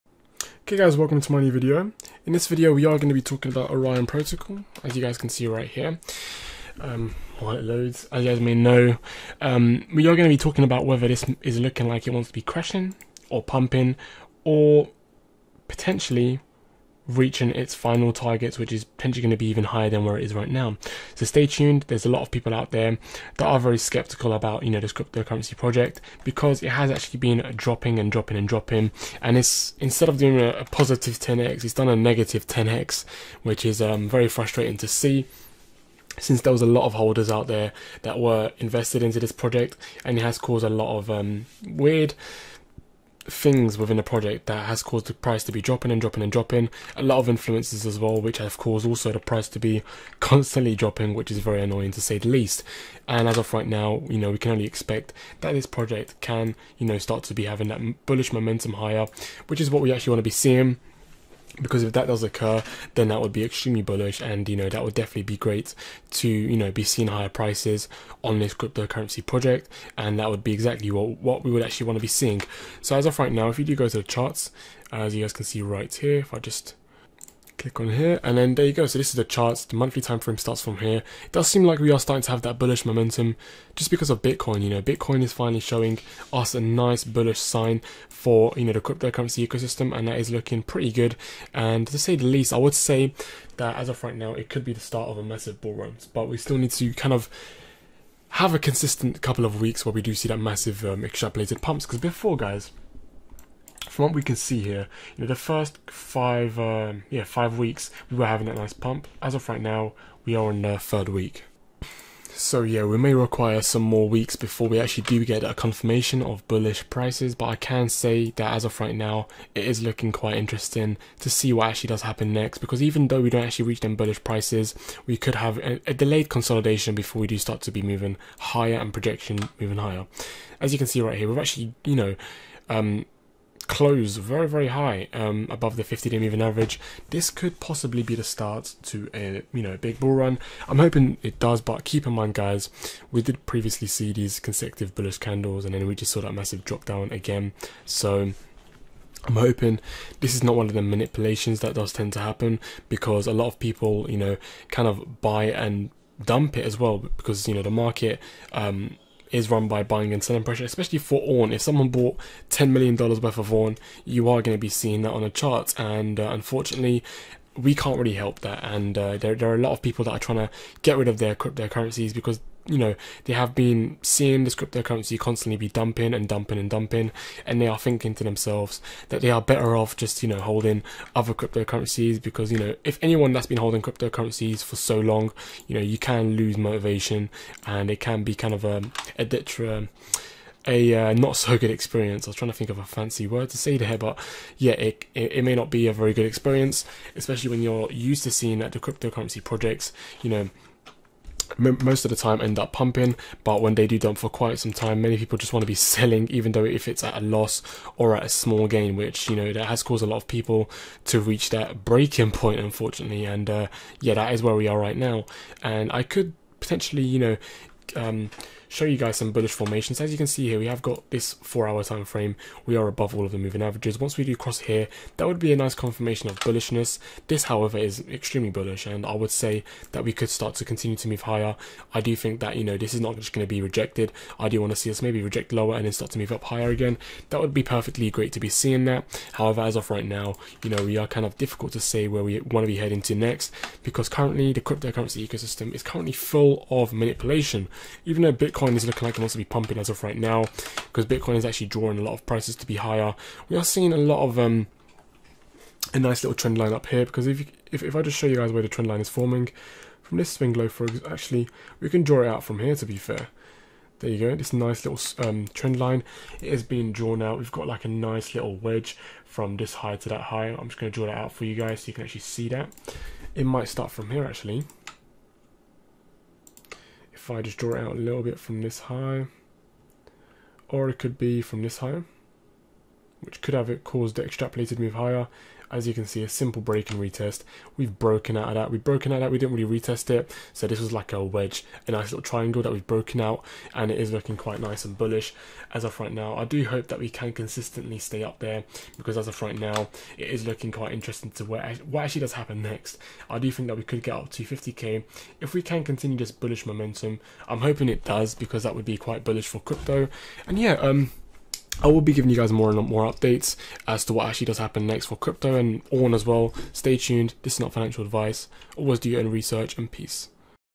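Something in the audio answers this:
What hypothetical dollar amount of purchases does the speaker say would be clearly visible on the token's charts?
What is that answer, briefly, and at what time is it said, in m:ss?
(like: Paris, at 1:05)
$10 million, at 2:42.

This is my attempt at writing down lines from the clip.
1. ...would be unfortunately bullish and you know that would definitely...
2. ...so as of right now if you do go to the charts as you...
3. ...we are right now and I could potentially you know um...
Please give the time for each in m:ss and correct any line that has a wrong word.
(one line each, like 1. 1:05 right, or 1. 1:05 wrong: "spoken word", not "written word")
1. 1:03 wrong: "extremely", not "unfortunately"
2. 1:12 right
3. 3:34 right.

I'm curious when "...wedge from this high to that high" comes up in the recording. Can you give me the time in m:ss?
4:28.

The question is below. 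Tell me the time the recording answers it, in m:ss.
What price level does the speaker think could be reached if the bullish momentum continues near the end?
5:04.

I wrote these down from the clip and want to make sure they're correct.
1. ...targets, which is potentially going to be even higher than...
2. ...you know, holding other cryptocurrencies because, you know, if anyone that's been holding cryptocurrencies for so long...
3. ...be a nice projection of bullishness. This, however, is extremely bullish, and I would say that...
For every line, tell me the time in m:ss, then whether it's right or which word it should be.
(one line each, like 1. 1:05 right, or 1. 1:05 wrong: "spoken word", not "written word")
1. 0:18 right
2. 3:00 right
3. 3:45 wrong: "confirmation", not "projection".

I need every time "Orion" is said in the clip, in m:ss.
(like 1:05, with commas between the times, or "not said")
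0:03.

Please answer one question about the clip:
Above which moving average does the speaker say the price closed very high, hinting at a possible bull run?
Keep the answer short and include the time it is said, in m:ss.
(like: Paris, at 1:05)
50 day moving average, at 2:15.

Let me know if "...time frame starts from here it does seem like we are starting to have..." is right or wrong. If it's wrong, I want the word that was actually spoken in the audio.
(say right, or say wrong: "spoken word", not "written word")
right.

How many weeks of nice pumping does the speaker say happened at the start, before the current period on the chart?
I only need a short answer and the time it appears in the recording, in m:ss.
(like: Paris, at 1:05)
5, at 1:47.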